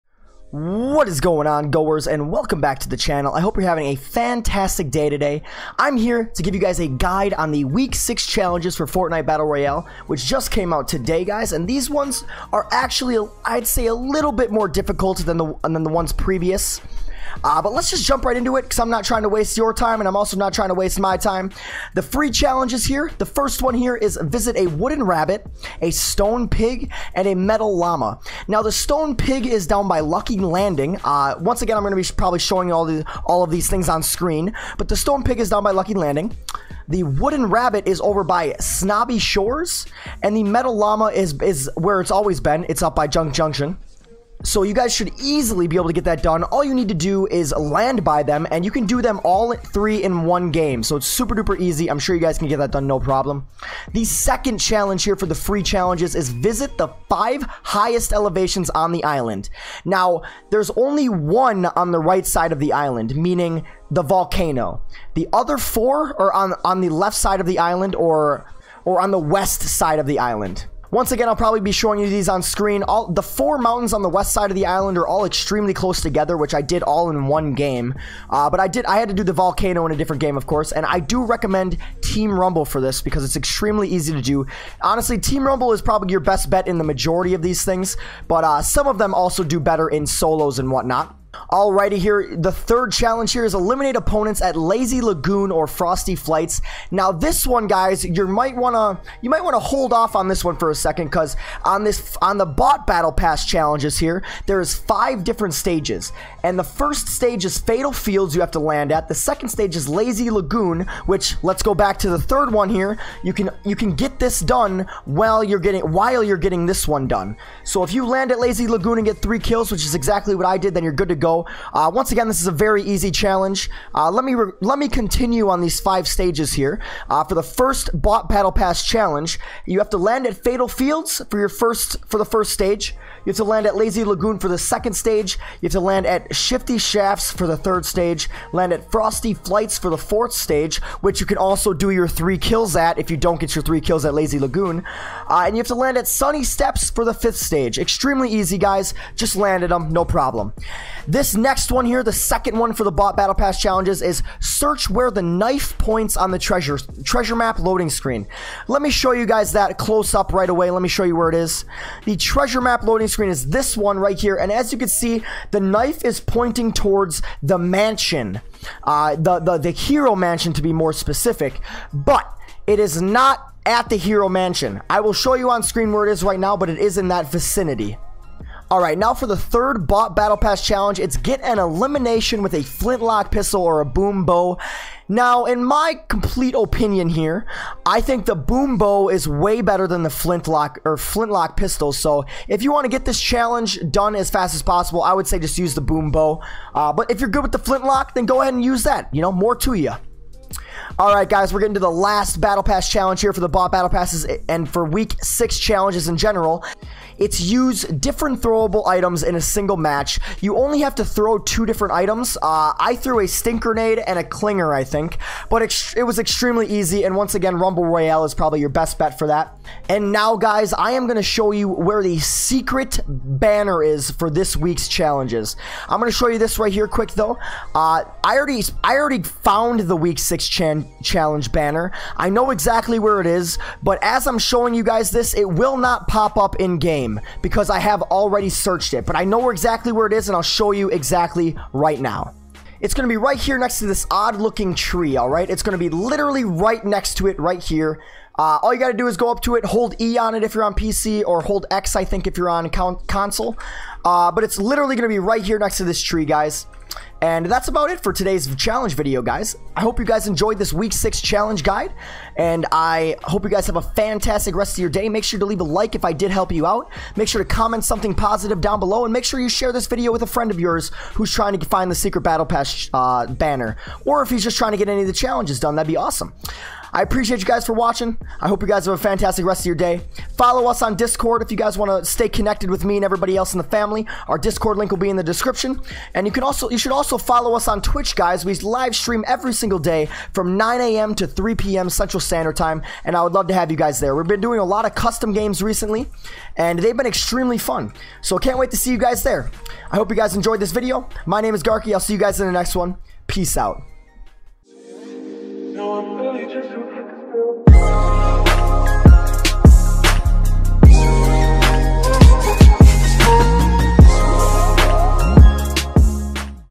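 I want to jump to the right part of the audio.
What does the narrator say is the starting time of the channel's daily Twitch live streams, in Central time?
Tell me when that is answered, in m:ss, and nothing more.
4:50.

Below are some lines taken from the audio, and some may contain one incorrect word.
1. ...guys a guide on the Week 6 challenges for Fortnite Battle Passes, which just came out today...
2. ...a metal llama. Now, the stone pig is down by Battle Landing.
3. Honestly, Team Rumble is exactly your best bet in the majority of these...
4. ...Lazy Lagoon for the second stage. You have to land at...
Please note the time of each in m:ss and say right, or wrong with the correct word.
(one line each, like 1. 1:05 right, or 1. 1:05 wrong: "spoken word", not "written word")
1. 0:06 wrong: "Royale", not "Passes"
2. 0:27 wrong: "Lucky", not "Battle"
3. 1:24 wrong: "probably", not "exactly"
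4. 2:13 right.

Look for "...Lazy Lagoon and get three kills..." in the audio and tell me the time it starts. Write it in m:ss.
1:58.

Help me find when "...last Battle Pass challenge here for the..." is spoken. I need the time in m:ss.
3:21.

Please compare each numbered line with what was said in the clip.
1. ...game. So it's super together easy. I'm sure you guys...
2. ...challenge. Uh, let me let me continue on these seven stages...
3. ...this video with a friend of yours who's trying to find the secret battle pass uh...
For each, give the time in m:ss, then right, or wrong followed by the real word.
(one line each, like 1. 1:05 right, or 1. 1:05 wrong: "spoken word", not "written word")
1. 0:50 wrong: "duper", not "together"
2. 2:03 wrong: "five", not "seven"
3. 4:29 right.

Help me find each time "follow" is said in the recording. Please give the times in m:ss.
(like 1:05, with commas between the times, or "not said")
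4:40, 4:47.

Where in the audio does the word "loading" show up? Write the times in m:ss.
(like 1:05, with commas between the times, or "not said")
2:37, 2:42.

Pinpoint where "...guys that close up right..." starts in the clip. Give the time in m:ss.
2:39.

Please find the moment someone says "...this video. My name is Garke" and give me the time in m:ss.
5:00.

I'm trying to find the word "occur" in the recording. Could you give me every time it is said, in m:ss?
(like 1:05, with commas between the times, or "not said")
not said.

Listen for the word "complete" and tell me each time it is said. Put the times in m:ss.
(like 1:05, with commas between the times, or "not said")
3:06.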